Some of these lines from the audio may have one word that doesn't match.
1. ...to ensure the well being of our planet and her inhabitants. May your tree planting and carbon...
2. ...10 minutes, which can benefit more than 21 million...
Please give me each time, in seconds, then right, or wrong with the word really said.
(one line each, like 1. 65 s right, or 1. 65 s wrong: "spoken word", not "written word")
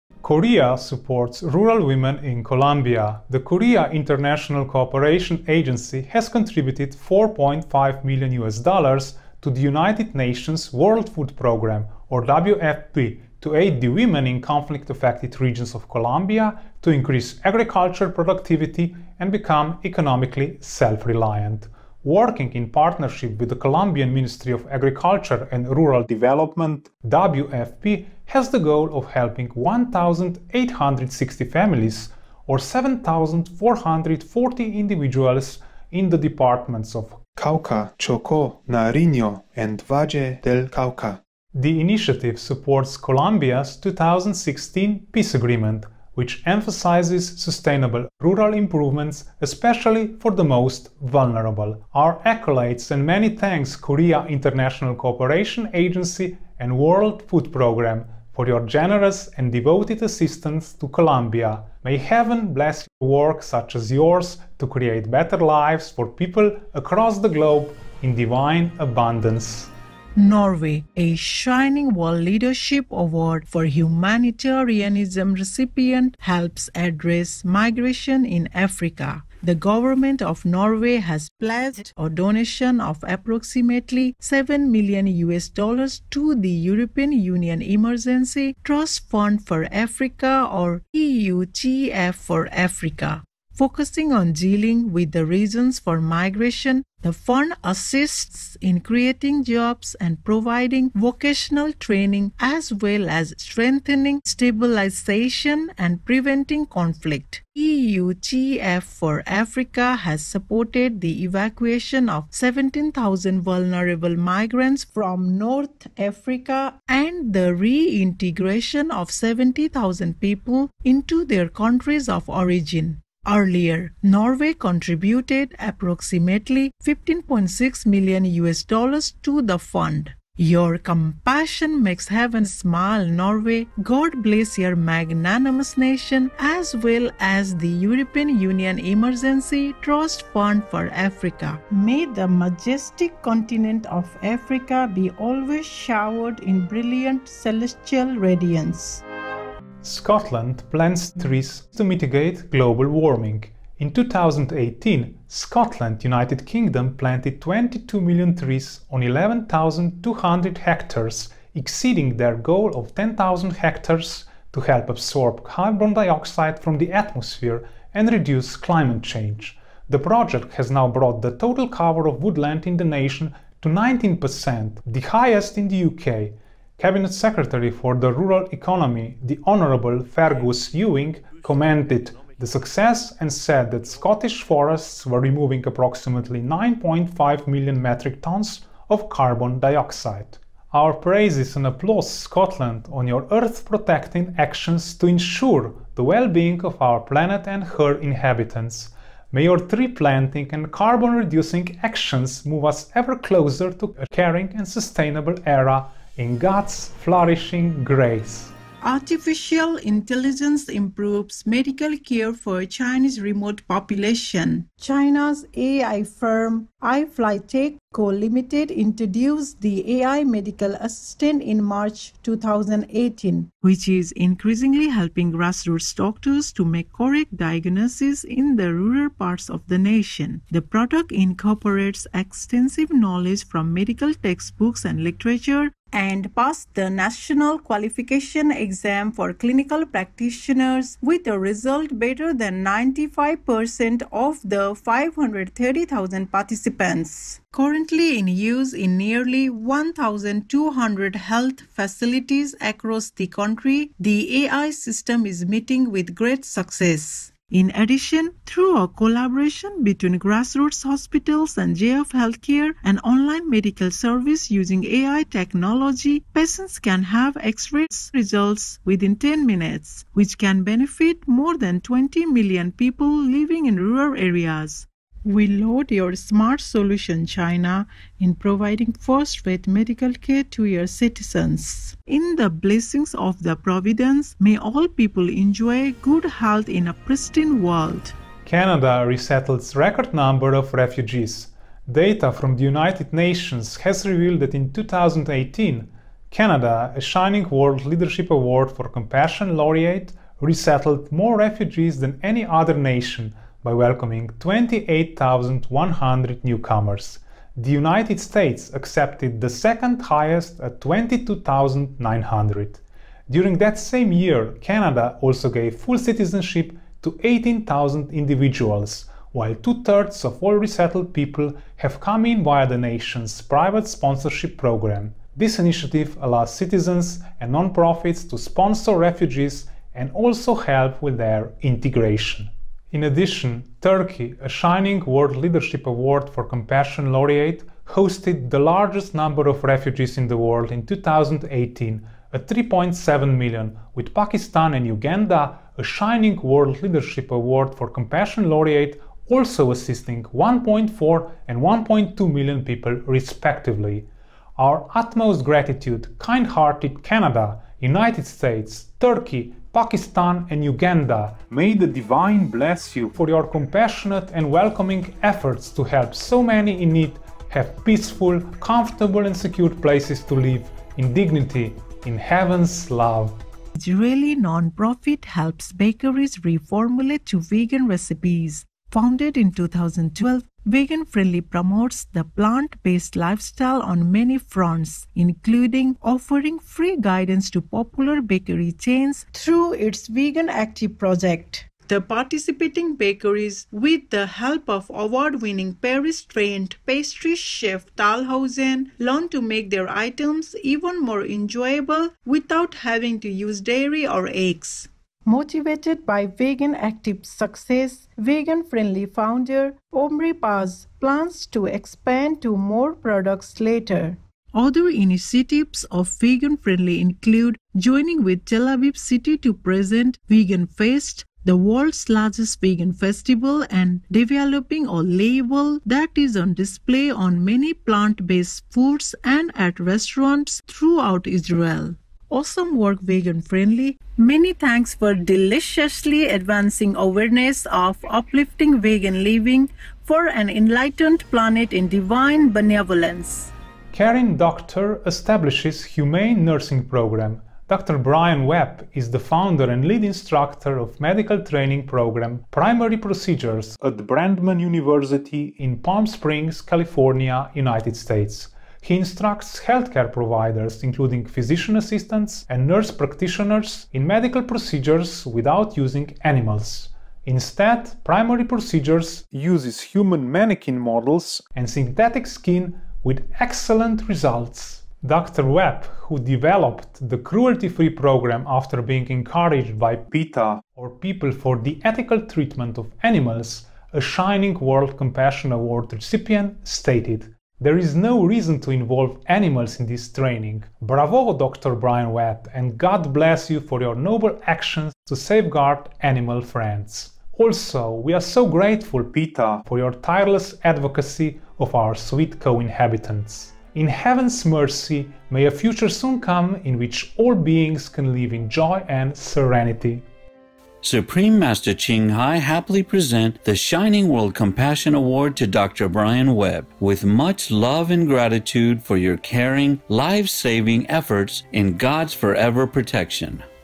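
1. 194 s right
2. 269 s wrong: "20", not "21".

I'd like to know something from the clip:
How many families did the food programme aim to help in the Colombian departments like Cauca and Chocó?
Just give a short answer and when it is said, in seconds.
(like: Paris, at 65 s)
1,860, at 29 s.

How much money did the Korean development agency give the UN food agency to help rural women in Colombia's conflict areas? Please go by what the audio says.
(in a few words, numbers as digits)
4.5 million US dollars.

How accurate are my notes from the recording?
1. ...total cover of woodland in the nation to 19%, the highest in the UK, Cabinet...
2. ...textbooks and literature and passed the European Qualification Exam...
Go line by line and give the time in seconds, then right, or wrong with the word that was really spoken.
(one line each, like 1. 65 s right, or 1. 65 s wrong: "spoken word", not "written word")
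1. 171 s right
2. 234 s wrong: "National", not "European".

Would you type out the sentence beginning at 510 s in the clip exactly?
Supreme Master Ching Hai happily present the Shining World Compassion Award to Dr.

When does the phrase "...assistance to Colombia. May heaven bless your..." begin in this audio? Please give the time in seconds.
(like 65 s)
60 s.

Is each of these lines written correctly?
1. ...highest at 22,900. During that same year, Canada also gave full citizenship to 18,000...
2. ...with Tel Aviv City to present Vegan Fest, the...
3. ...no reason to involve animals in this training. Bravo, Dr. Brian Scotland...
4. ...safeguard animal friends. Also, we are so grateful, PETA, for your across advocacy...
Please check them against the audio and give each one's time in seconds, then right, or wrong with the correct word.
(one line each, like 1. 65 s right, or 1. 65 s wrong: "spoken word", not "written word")
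1. 310 s right
2. 418 s right
3. 487 s wrong: "Webb", not "Scotland"
4. 495 s wrong: "tireless", not "across".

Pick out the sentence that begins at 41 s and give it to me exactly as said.
The initiative supports Colombia's 2016 peace agreement which emphasizes sustainable rural improvements, especially for the most vulnerable.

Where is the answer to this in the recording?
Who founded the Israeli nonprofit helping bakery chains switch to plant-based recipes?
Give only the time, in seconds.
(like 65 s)
409 s.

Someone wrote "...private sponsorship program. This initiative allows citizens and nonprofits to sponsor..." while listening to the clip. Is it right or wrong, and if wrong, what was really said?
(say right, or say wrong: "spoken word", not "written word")
right.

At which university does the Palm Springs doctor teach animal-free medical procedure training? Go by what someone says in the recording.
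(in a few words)
Brandman University.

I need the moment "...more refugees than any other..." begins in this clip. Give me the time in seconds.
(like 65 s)
301 s.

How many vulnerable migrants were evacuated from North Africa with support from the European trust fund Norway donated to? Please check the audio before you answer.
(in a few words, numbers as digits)
17,000.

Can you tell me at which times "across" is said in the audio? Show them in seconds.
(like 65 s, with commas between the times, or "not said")
66 s, 252 s.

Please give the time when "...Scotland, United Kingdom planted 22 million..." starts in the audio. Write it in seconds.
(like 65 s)
155 s.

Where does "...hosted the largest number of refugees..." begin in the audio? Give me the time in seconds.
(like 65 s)
337 s.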